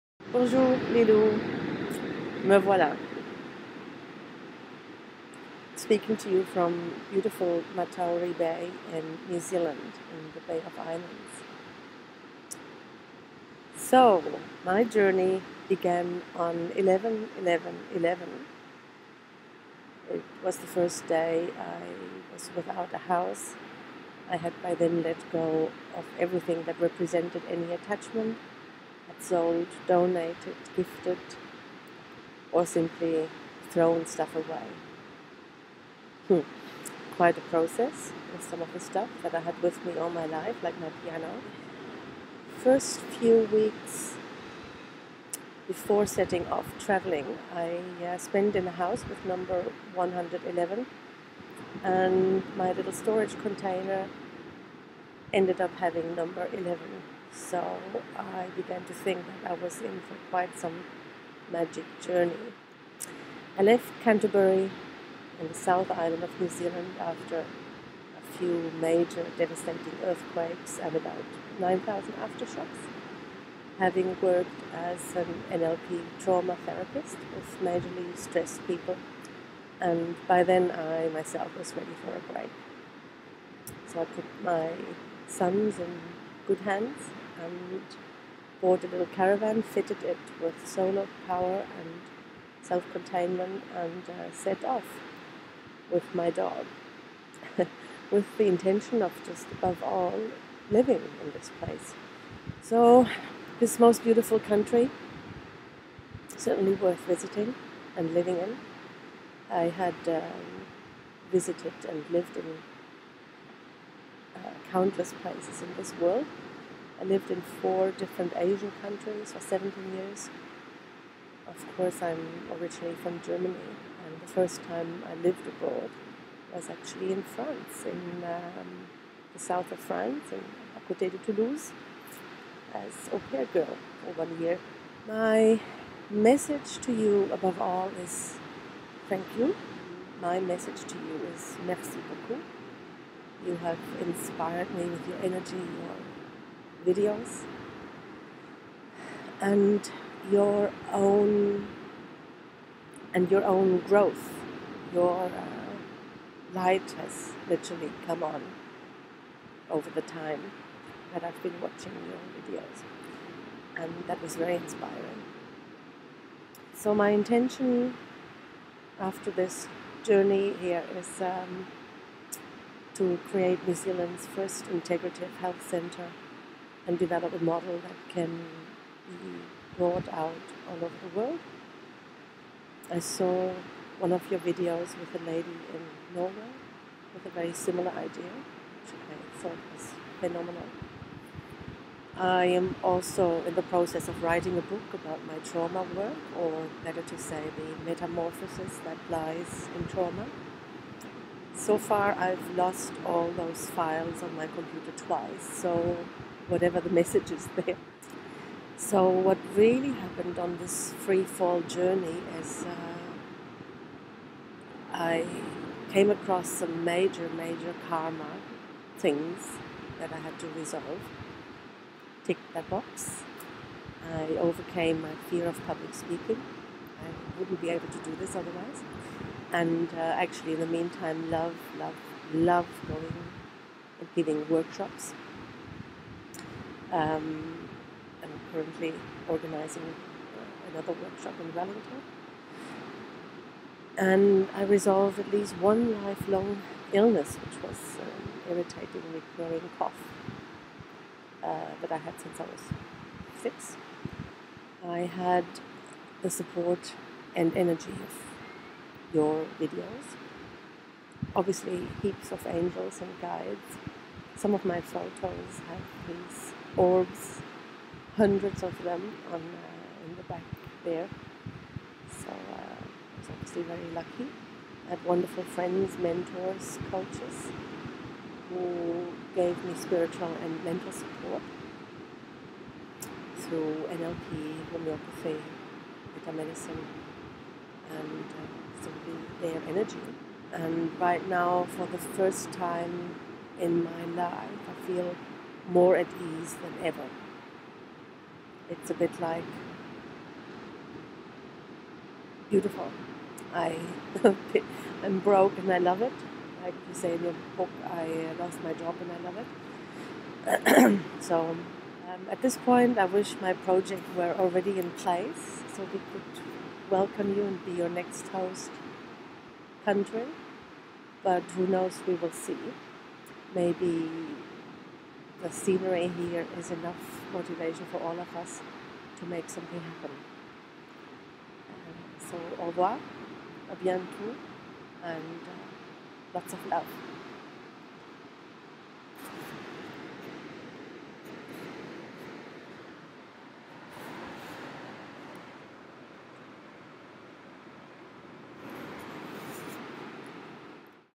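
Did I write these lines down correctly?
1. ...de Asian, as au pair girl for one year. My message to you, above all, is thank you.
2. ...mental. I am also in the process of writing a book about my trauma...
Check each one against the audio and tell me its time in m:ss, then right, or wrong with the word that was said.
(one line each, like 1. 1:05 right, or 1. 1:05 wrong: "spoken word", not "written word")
1. 2:11 wrong: "Toulouse", not "Asian"
2. 3:10 wrong: "phenomenal", not "mental".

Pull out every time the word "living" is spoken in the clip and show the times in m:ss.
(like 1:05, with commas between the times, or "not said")
1:40, 1:48.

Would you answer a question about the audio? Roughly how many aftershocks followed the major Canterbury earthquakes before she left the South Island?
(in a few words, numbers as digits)
9,000.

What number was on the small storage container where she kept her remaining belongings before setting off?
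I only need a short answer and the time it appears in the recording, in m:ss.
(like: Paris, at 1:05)
11, at 0:56.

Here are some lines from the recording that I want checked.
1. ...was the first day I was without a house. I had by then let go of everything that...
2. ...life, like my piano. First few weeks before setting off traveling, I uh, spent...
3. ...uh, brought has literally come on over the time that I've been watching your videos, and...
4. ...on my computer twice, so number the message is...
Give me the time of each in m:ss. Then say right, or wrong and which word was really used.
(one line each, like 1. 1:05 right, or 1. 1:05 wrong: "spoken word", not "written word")
1. 0:20 right
2. 0:40 right
3. 2:35 wrong: "light", not "brought"
4. 3:24 wrong: "whatever", not "number".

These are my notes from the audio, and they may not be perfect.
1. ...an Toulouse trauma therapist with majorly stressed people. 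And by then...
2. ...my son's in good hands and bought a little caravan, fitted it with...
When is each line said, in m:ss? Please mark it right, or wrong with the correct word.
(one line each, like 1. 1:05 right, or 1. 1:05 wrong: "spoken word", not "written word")
1. 1:15 wrong: "NLP", not "Toulouse"
2. 1:24 right.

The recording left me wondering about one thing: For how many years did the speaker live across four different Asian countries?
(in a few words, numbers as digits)
17.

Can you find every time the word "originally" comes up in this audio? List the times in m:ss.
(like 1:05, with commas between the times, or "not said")
2:02.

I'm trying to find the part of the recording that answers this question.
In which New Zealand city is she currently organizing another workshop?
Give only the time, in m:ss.
4:01.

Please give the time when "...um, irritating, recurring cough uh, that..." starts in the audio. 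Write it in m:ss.
4:08.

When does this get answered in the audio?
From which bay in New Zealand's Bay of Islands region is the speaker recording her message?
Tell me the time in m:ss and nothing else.
0:07.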